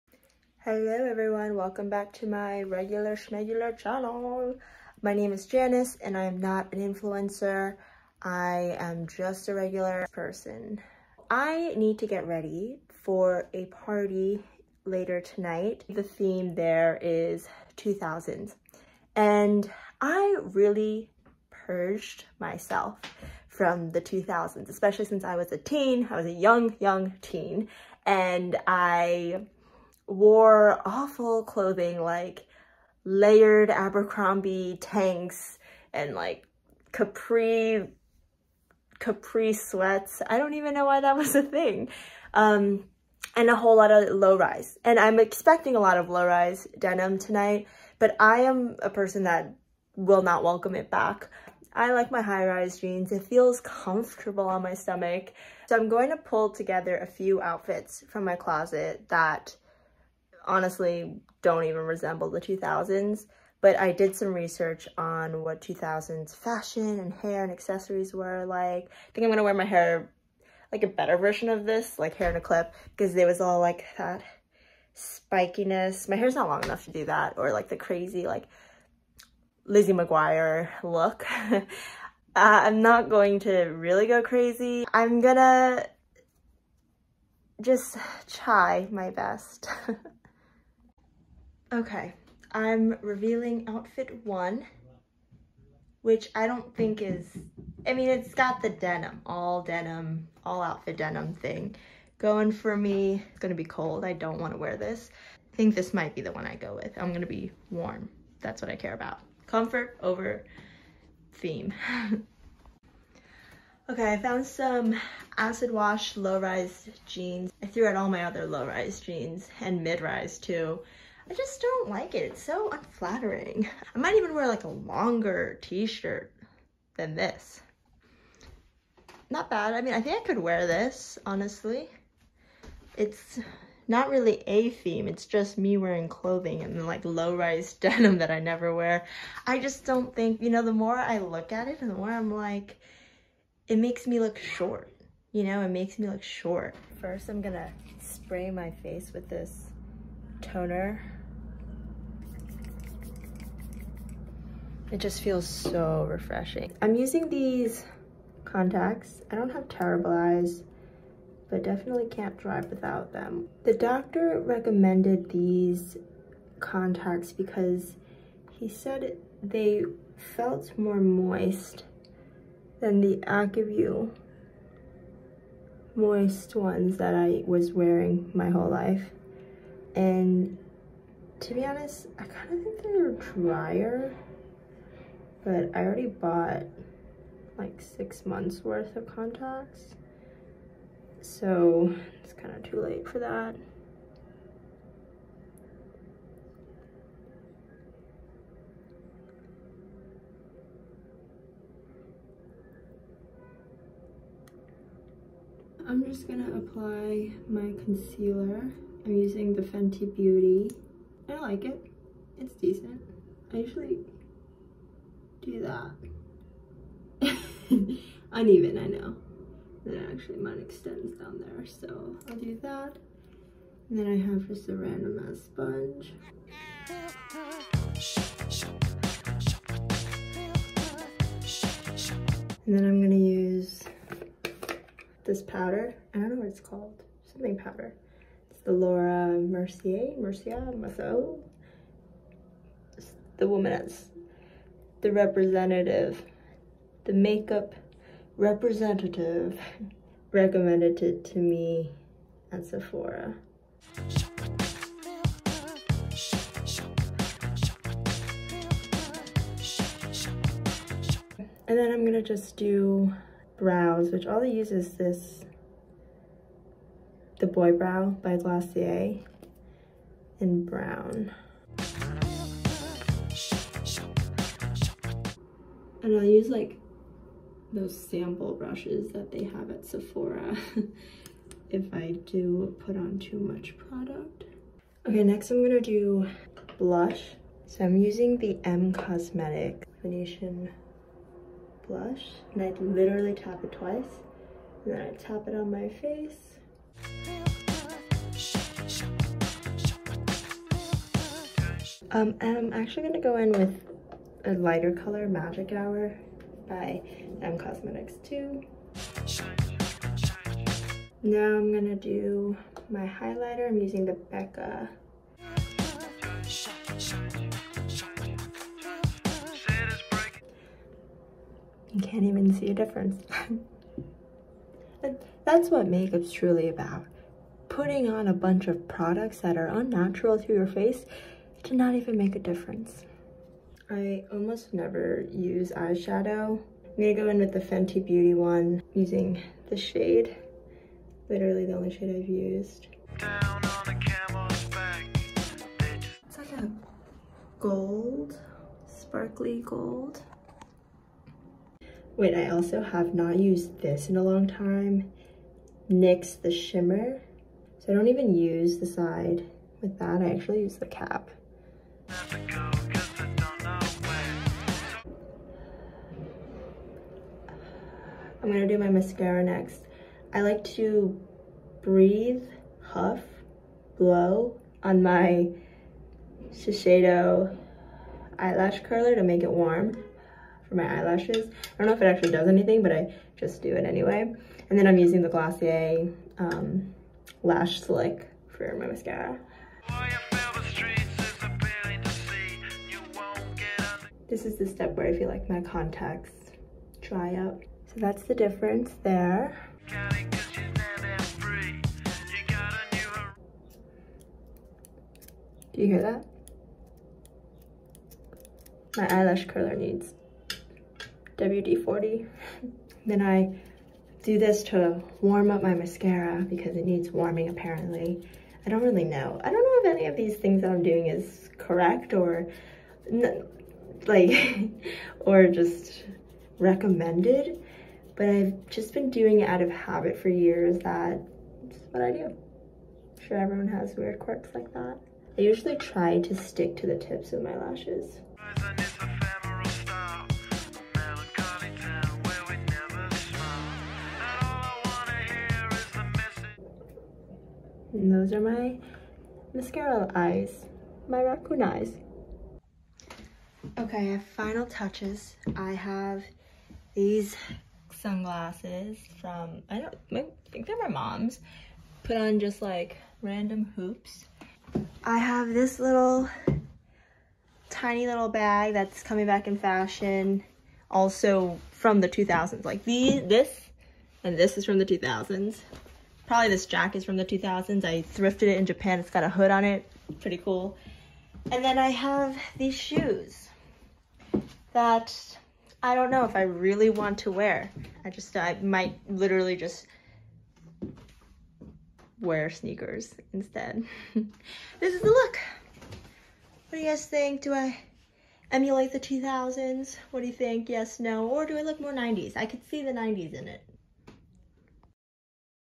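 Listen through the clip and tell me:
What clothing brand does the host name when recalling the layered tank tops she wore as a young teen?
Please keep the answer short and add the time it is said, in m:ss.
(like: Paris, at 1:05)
Abercrombie, at 0:33.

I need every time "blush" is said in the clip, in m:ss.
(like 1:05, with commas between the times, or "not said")
4:46, 4:51.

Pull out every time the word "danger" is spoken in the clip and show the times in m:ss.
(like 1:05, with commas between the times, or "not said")
not said.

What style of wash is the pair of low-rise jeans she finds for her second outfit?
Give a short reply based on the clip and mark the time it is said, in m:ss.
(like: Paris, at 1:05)
acid wash, at 1:55.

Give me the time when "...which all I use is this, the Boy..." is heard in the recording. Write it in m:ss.
4:24.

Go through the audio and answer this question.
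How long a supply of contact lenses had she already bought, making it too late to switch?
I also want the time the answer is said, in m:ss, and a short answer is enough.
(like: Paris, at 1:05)
six months, at 3:07.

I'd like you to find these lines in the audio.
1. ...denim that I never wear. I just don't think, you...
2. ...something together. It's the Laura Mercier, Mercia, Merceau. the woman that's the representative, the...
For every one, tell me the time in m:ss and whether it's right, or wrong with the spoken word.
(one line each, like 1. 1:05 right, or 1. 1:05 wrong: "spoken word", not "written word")
1. 2:17 right
2. 3:57 wrong: "powder", not "together".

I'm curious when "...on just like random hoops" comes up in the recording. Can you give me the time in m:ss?
7:42.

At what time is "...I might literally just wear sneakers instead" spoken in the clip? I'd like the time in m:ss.
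8:08.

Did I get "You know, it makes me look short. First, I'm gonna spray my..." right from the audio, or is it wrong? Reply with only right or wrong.
right.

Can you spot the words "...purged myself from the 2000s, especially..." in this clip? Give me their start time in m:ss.
0:21.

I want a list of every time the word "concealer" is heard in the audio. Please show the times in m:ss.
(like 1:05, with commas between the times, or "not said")
3:27.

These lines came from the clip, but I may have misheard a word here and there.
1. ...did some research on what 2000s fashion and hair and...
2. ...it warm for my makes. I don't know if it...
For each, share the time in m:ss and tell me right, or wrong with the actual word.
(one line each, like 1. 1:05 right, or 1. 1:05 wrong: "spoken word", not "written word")
1. 1:03 right
2. 6:19 wrong: "eyelashes", not "makes".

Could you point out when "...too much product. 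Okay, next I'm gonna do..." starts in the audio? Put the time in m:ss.
4:43.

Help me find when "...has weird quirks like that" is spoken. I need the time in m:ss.
7:13.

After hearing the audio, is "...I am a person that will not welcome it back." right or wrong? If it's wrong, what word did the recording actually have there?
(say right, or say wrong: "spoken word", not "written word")
right.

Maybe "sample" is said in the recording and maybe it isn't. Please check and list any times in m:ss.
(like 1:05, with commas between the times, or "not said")
4:38.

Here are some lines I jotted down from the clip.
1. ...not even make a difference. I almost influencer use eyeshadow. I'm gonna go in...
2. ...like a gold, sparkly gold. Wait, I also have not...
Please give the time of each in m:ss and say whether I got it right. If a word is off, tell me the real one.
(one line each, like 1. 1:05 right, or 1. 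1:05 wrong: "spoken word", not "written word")
1. 5:31 wrong: "never", not "influencer"
2. 5:46 right.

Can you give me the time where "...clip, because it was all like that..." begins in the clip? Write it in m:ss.
1:12.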